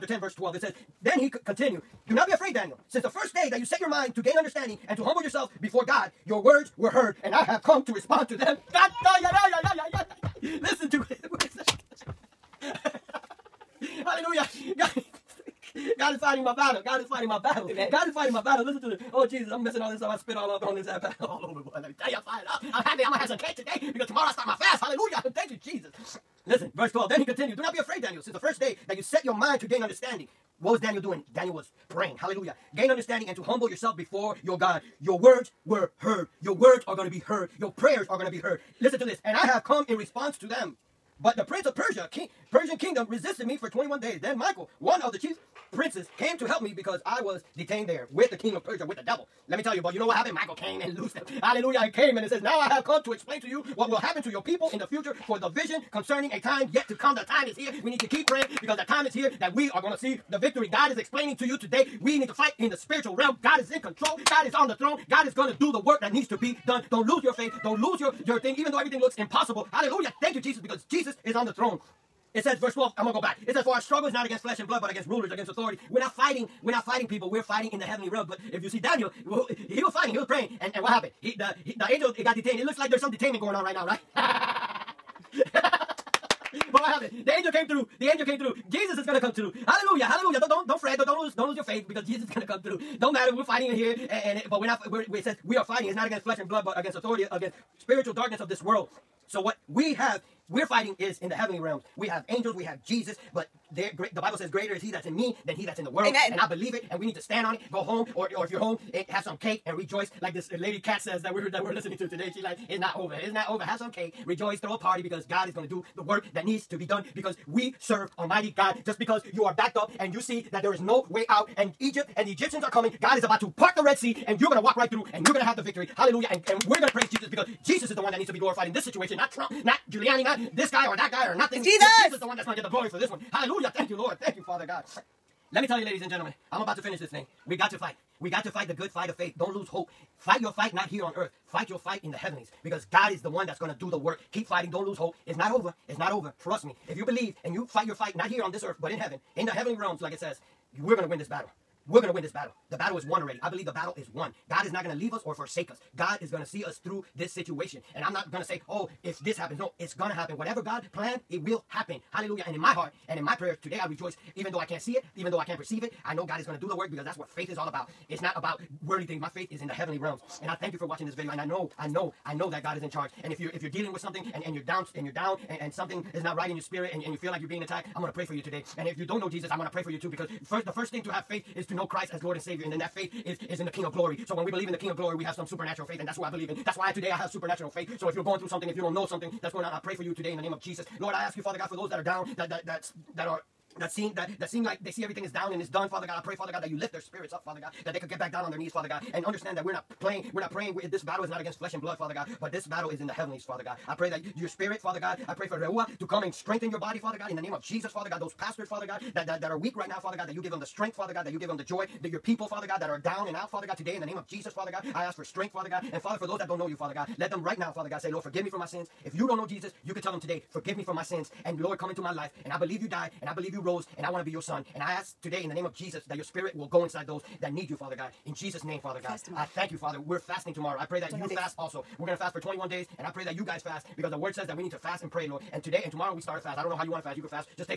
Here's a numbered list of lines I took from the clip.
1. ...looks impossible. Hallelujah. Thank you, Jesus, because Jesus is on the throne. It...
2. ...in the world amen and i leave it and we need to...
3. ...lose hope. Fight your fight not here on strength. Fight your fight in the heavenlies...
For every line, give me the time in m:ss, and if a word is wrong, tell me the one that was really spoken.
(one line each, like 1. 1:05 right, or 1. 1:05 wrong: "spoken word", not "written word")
1. 1:09 right
2. 1:45 wrong: "believe", not "leave"
3. 2:19 wrong: "earth", not "strength".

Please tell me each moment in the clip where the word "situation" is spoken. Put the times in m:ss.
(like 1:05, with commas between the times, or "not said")
2:08, 2:37.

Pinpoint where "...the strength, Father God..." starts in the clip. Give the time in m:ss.
3:30.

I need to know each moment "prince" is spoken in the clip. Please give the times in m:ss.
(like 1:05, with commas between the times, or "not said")
0:41, 0:45.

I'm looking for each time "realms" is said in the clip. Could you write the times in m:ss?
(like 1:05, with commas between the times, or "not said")
1:03, 1:18, 1:41, 2:29, 2:49.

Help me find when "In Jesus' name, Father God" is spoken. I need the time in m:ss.
3:48.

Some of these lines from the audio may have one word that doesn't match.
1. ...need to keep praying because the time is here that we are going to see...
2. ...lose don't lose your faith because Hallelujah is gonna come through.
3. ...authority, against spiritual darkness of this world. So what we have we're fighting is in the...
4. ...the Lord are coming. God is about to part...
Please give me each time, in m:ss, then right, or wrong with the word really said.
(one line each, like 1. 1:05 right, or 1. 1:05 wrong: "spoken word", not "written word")
1. 0:57 right
2. 1:31 wrong: "Jesus", not "Hallelujah"
3. 1:36 right
4. 2:02 wrong: "Egyptians", not "Lord".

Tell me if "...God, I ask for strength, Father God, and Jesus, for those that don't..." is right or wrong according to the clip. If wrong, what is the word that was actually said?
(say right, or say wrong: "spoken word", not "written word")
wrong: "Father", not "Jesus".